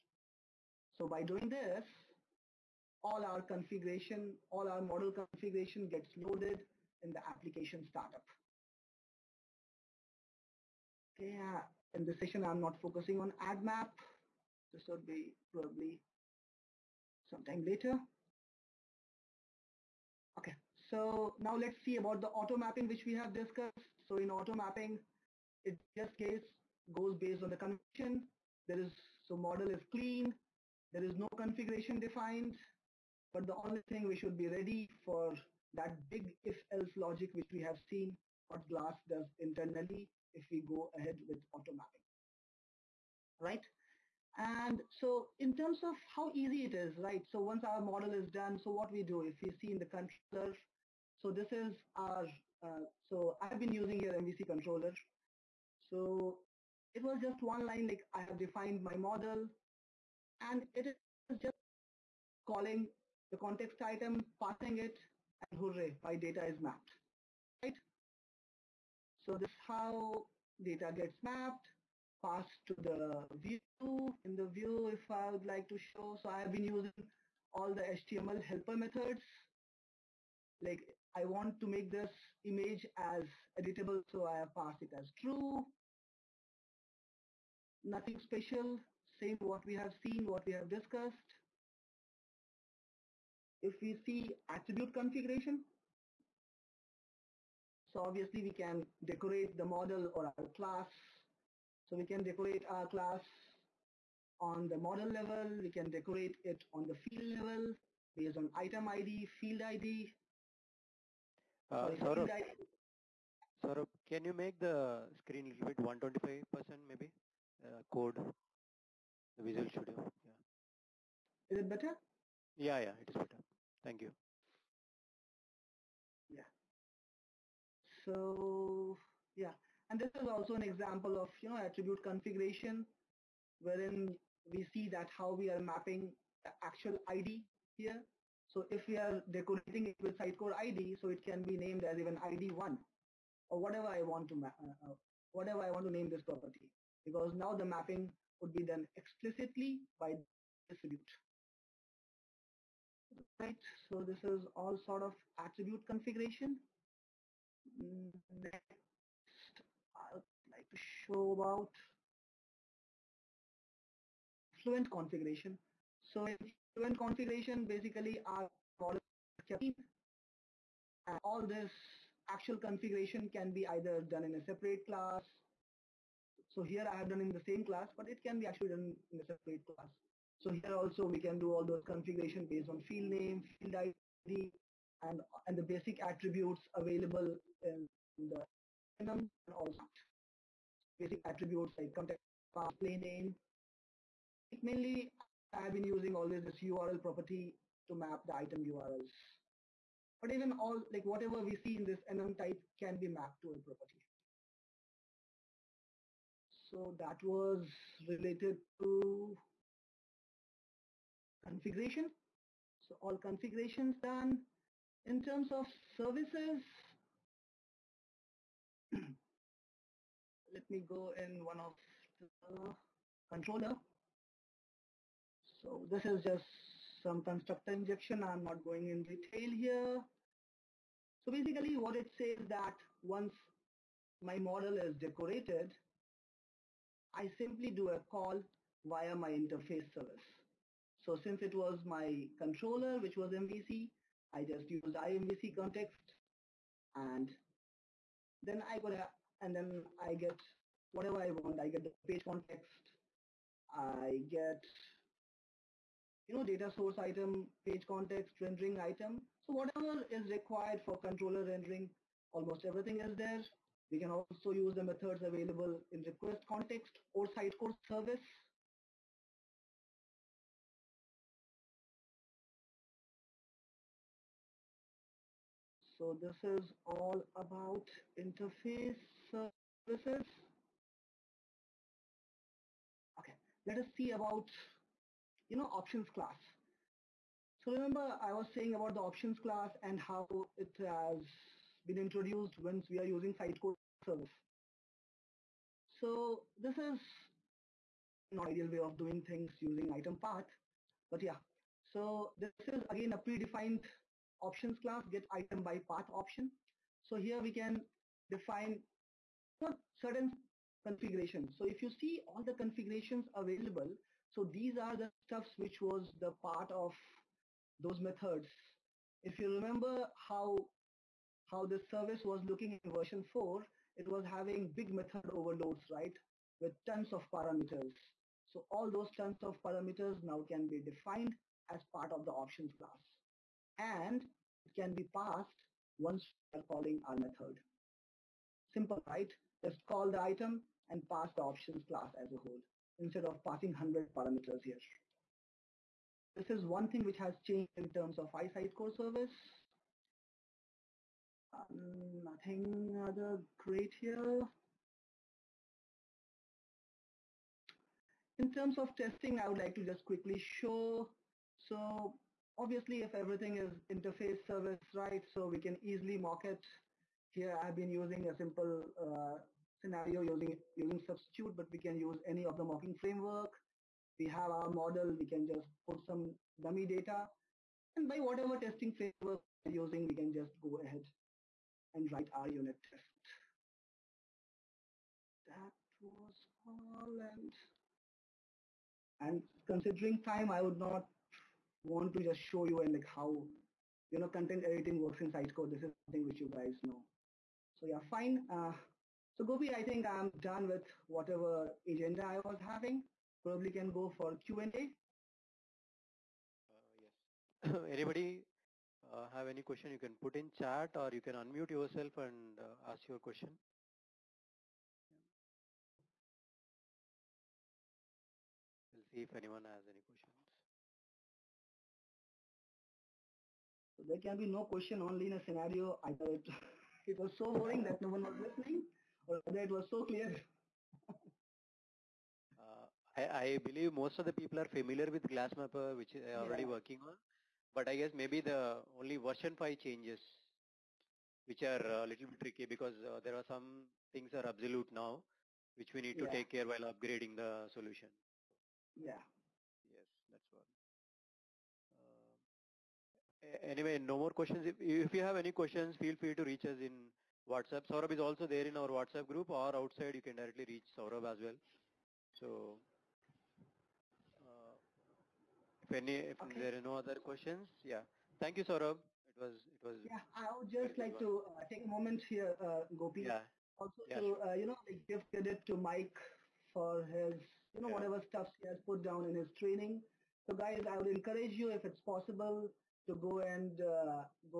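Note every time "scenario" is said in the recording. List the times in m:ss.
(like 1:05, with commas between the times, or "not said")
6:09, 7:05.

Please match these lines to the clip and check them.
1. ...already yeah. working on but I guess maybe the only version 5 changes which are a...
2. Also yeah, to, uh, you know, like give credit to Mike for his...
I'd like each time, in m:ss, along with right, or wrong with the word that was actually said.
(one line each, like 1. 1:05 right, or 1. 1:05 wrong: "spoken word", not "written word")
1. 7:16 right
2. 7:53 right.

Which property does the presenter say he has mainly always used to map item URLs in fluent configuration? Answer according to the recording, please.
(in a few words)
URL property.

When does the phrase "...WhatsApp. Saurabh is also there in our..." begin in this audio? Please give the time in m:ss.
7:37.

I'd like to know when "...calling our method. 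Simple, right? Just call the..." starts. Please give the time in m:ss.
5:36.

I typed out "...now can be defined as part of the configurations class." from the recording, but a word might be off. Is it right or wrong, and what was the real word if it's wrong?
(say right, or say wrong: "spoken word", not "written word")
wrong: "options", not "configurations".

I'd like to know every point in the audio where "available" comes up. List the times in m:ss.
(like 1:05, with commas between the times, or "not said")
3:06, 4:25, 5:13.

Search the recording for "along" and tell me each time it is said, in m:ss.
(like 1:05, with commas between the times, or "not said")
not said.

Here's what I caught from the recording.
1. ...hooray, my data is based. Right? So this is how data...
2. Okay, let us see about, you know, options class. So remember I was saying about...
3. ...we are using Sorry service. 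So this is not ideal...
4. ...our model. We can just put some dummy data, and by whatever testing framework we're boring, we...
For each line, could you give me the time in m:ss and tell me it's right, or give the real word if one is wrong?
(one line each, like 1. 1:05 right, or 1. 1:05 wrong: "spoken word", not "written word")
1. 1:05 wrong: "mapped", not "based"
2. 4:43 right
3. 4:52 wrong: "Sitecore", not "Sorry"
4. 6:14 wrong: "using", not "boring".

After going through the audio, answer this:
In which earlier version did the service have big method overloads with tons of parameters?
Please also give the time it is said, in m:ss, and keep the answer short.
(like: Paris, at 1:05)
version 4, at 5:22.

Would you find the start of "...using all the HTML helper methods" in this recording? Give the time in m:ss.
1:16.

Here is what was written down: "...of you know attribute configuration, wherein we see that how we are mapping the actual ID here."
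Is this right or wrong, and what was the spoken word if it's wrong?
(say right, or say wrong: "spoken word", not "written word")
right.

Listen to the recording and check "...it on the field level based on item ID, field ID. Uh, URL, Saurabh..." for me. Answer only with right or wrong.
wrong.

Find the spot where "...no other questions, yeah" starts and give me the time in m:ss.
7:46.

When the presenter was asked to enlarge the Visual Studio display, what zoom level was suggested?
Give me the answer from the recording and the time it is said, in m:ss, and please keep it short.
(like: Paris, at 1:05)
125%, at 1:55.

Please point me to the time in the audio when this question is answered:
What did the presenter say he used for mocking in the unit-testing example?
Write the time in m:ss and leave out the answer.
6:11.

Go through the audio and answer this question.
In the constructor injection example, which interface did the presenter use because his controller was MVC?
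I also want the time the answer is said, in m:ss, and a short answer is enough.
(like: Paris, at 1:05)
IMVC context, at 4:04.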